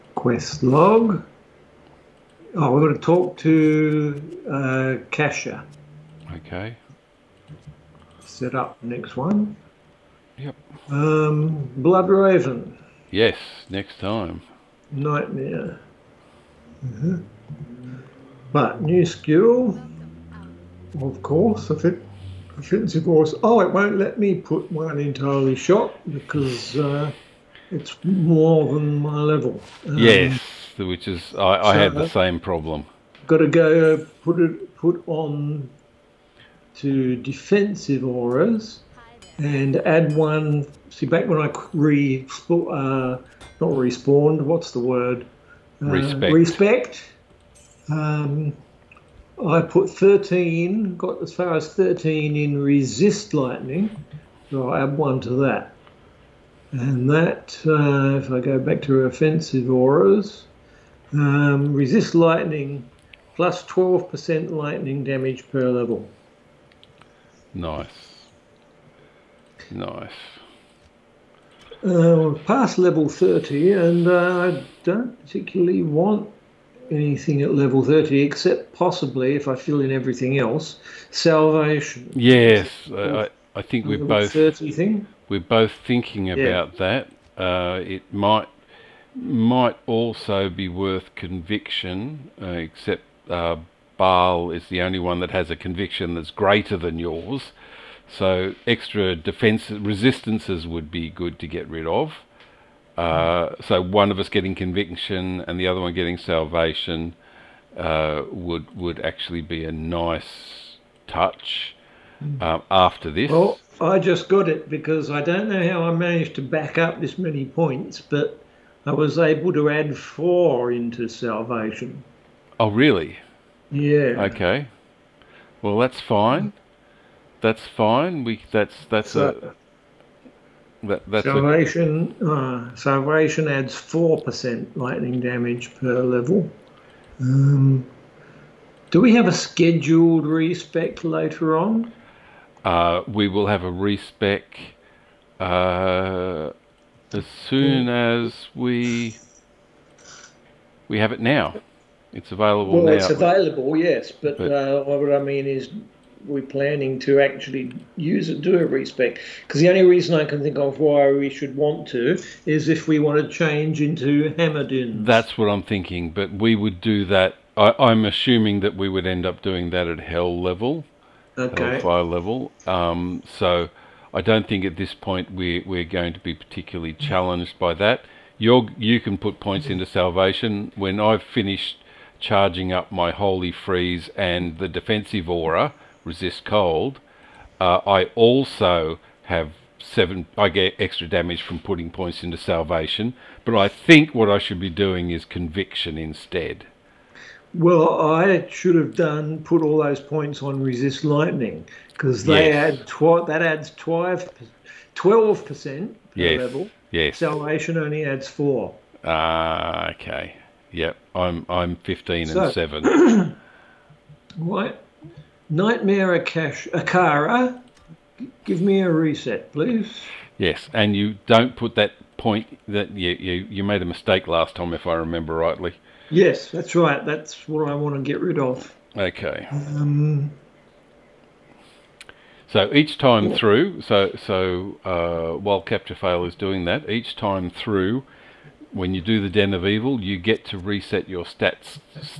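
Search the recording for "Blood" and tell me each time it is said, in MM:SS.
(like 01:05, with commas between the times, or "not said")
00:11.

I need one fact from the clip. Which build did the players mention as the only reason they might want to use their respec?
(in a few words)
Hammerdin.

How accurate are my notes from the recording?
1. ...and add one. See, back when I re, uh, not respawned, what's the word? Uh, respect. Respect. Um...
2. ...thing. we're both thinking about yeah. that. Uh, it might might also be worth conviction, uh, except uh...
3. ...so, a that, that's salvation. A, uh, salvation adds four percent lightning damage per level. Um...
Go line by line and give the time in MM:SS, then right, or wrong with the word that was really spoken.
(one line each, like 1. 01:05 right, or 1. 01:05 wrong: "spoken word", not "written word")
1. 00:39 right
2. 01:24 right
3. 02:09 right.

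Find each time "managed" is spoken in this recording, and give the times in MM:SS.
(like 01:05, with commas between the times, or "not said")
01:55.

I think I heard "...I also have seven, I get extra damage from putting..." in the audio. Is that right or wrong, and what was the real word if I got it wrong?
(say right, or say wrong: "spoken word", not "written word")
right.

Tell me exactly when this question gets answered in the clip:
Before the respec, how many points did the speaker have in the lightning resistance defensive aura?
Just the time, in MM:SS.
00:50.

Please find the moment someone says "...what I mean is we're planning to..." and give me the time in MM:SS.
02:34.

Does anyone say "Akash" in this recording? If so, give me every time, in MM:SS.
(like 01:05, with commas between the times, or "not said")
03:36.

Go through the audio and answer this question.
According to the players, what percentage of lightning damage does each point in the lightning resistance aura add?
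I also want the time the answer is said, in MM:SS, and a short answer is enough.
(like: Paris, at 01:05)
12%, at 01:03.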